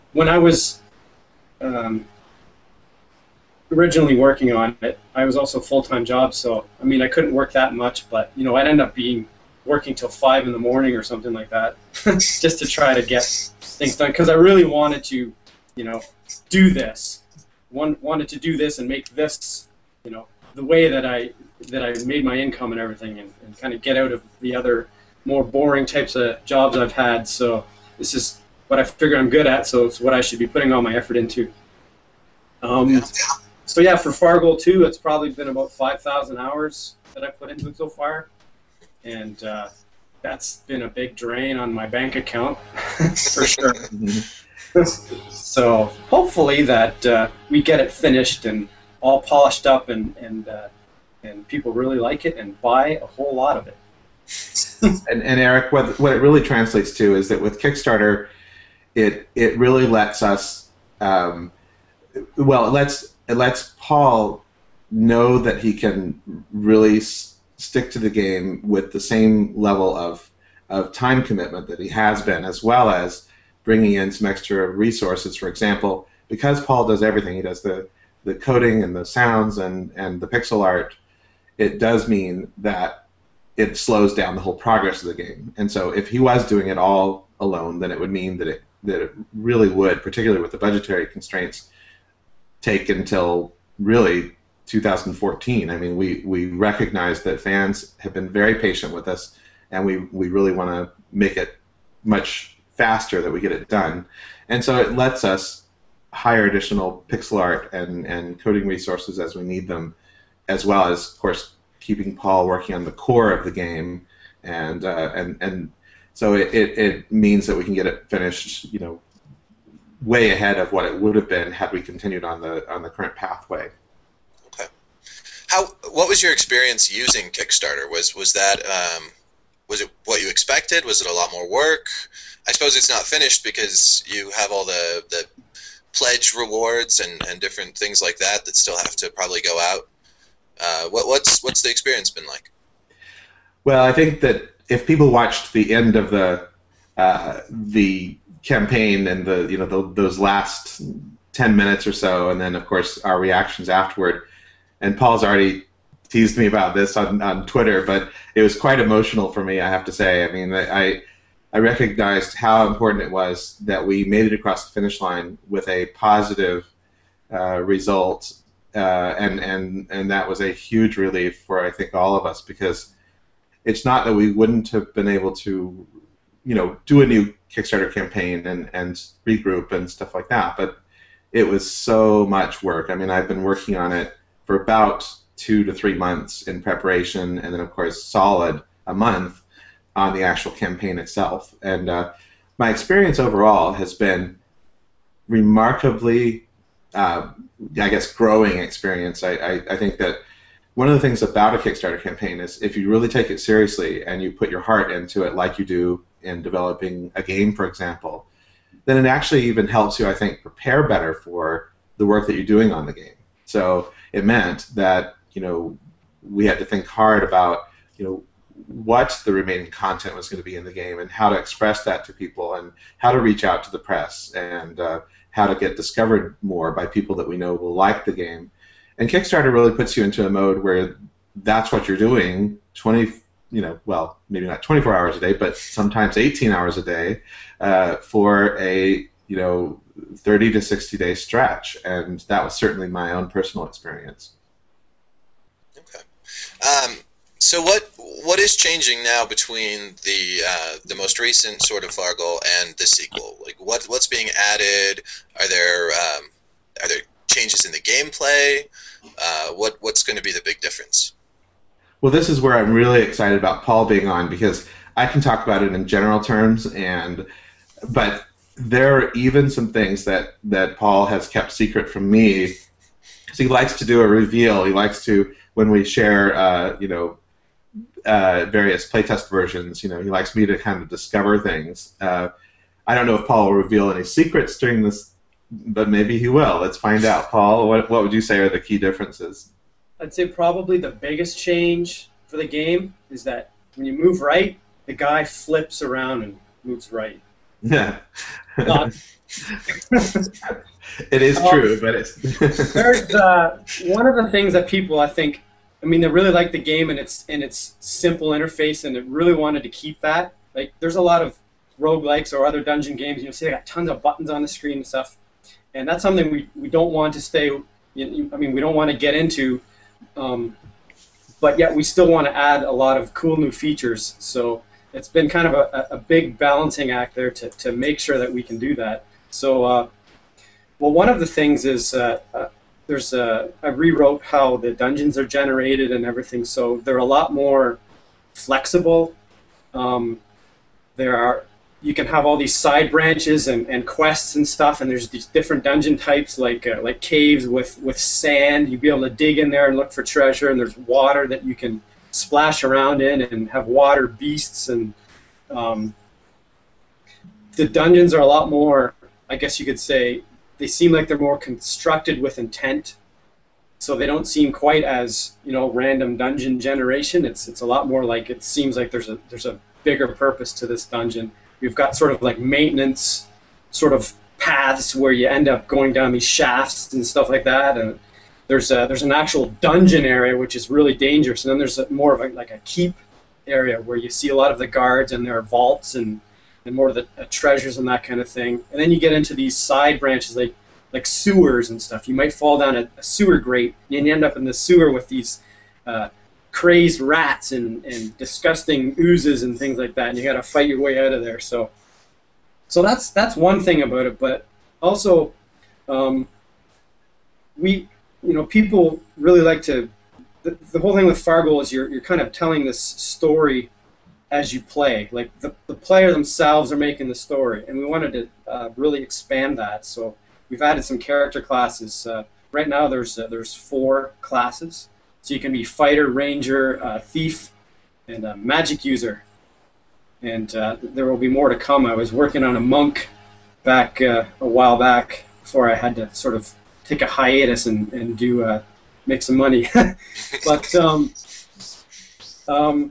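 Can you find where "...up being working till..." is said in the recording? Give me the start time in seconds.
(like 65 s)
8 s.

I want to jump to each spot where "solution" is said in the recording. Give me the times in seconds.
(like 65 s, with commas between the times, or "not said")
not said.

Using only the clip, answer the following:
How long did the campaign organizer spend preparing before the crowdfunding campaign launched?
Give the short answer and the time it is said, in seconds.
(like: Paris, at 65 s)
two to three months, at 185 s.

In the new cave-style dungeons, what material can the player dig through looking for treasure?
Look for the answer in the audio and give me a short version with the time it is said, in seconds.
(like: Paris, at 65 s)
sand, at 347 s.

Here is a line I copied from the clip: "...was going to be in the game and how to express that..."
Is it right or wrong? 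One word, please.
right.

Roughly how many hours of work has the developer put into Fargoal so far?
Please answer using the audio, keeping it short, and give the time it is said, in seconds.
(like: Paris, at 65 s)
5,000, at 35 s.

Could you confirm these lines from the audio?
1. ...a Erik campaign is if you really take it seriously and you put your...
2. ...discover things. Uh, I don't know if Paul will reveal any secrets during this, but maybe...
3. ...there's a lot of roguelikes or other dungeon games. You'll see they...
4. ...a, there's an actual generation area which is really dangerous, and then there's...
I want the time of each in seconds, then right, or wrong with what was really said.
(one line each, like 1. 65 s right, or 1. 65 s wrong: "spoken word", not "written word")
1. 201 s wrong: "Kickstarter", not "Erik"
2. 280 s right
3. 310 s right
4. 378 s wrong: "dungeon", not "generation".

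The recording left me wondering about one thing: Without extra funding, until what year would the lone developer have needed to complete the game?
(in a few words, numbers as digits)
2014.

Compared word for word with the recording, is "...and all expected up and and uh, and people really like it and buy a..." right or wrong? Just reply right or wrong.
wrong.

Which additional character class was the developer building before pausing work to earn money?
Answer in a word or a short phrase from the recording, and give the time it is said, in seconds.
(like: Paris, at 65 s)
monk, at 432 s.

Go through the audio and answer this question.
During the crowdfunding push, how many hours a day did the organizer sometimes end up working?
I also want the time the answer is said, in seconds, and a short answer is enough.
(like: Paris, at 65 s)
18, at 236 s.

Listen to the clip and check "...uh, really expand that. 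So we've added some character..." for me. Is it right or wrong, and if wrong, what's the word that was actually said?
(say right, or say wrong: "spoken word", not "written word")
right.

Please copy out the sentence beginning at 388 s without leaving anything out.
And then you get into these side branches like like sewers and stuff.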